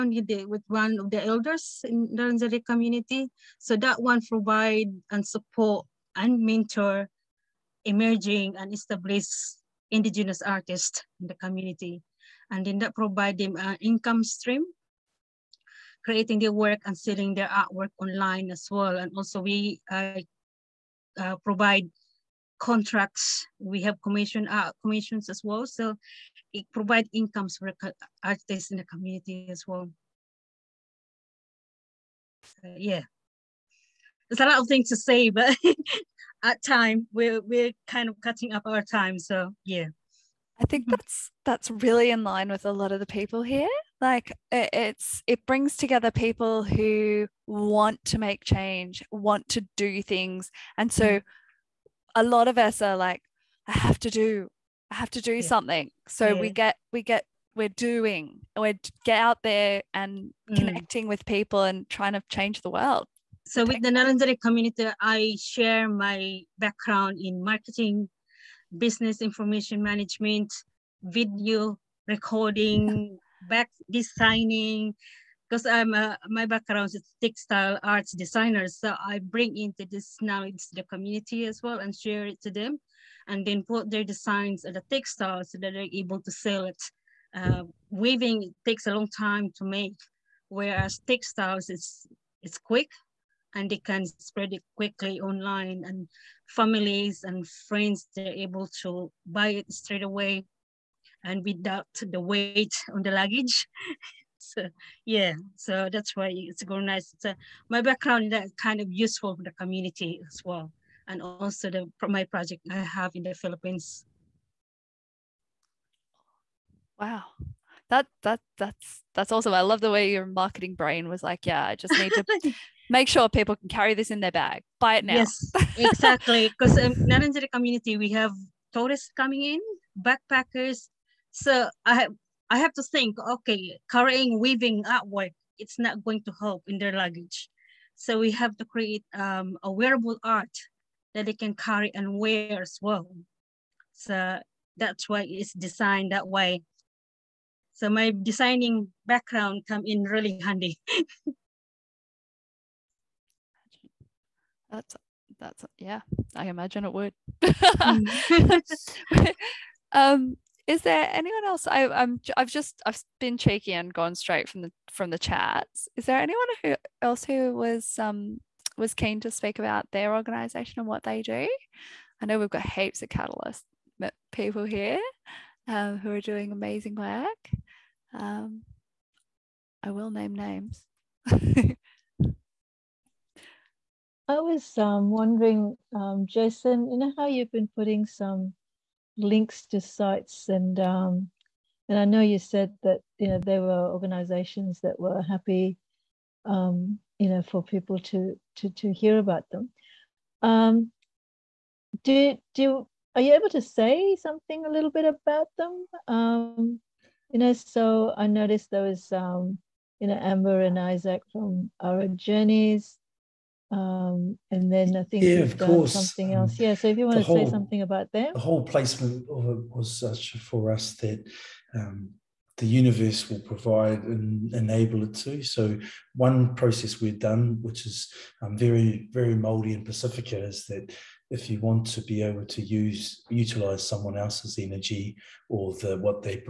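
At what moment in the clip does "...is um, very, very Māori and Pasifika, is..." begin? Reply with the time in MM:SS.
03:47.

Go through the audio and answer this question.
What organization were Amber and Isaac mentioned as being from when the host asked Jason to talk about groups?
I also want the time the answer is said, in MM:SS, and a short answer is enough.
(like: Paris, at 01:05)
Our Journeys, at 03:31.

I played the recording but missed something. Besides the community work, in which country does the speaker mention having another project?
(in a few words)
Philippines.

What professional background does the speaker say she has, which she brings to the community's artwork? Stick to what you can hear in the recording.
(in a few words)
Textile arts designer.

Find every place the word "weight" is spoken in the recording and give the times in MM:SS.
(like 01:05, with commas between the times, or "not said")
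01:42.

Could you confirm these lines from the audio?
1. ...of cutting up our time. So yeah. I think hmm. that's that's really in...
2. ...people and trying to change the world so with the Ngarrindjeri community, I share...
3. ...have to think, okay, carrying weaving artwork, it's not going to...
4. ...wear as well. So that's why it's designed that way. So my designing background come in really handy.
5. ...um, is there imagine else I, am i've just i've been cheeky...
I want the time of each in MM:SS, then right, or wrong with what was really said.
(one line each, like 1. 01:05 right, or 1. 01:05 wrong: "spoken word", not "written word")
1. 00:38 right
2. 01:01 right
3. 02:12 right
4. 02:22 right
5. 02:39 wrong: "anyone", not "imagine".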